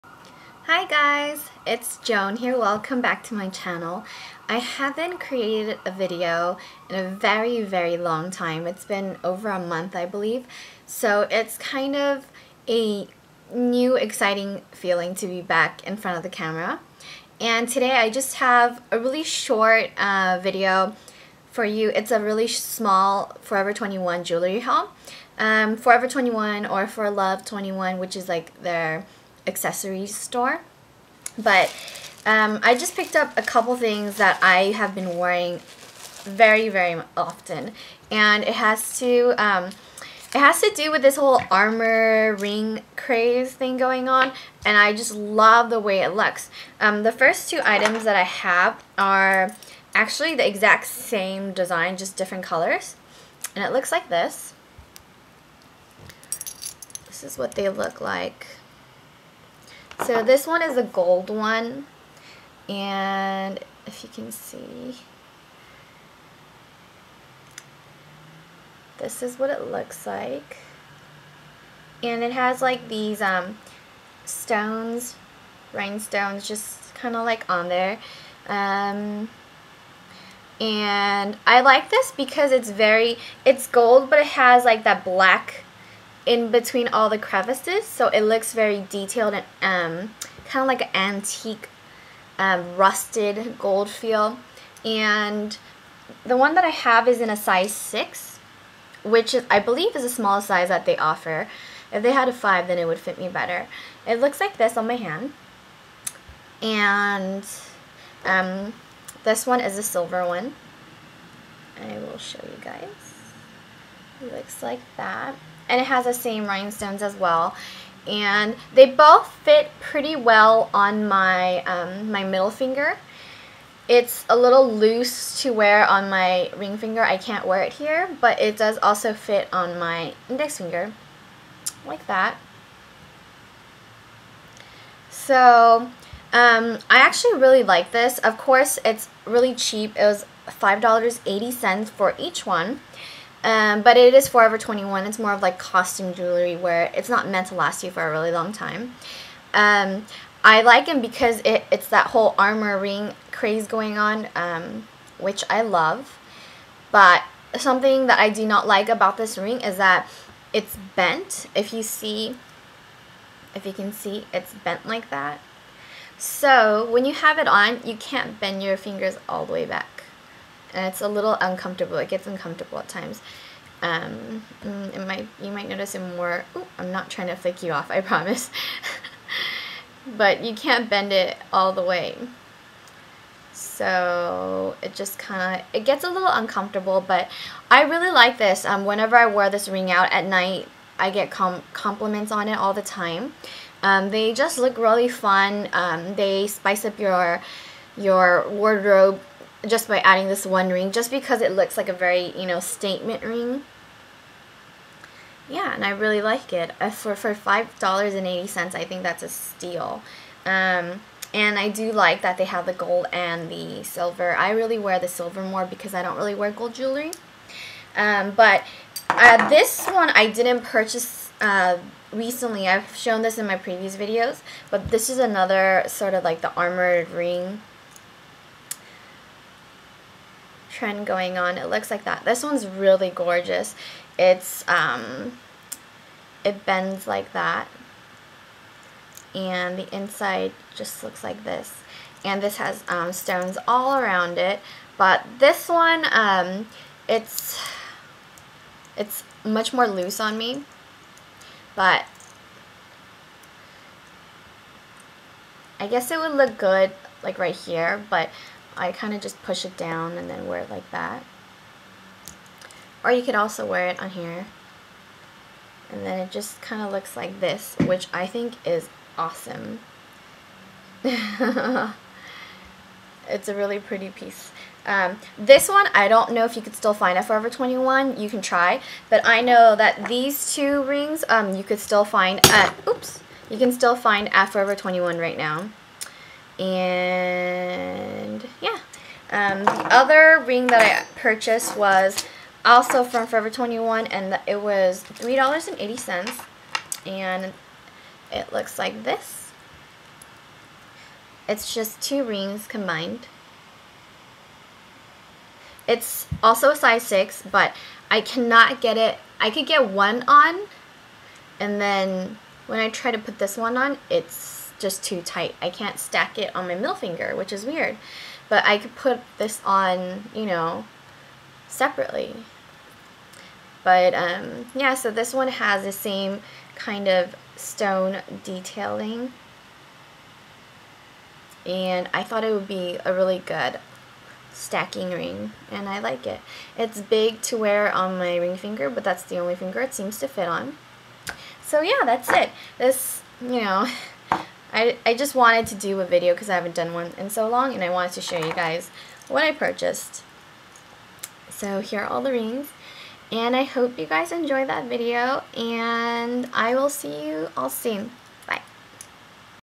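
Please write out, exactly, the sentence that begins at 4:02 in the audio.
And this has um, stones all around it.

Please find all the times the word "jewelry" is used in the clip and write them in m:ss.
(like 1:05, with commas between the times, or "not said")
0:24, 2:26, 3:36.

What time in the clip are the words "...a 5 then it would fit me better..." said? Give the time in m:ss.
1:42.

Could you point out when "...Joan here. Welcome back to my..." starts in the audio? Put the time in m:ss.
0:01.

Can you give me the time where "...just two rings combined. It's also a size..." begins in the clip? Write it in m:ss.
5:01.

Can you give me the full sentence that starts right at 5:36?
It's big to wear on my ring finger but that's the only finger it seems to fit on.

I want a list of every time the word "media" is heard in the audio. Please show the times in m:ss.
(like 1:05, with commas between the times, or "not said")
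not said.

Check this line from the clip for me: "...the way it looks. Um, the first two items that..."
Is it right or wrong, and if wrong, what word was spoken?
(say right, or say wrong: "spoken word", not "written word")
right.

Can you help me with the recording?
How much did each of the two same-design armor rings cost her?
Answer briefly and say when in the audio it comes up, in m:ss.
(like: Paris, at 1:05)
$5.80, at 2:20.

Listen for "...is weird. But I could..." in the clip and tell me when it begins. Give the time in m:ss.
5:17.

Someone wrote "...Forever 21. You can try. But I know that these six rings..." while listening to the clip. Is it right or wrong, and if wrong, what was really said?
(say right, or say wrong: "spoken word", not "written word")
wrong: "two", not "six".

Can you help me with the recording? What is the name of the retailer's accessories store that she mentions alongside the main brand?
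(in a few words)
For Love 21.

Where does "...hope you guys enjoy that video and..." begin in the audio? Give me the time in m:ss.
5:53.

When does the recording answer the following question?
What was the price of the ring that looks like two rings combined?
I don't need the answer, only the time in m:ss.
4:55.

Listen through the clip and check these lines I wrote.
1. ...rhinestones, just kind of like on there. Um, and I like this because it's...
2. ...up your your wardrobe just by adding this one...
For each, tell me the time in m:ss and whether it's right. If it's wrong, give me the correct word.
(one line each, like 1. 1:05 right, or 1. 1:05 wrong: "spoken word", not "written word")
1. 1:15 right
2. 3:16 right.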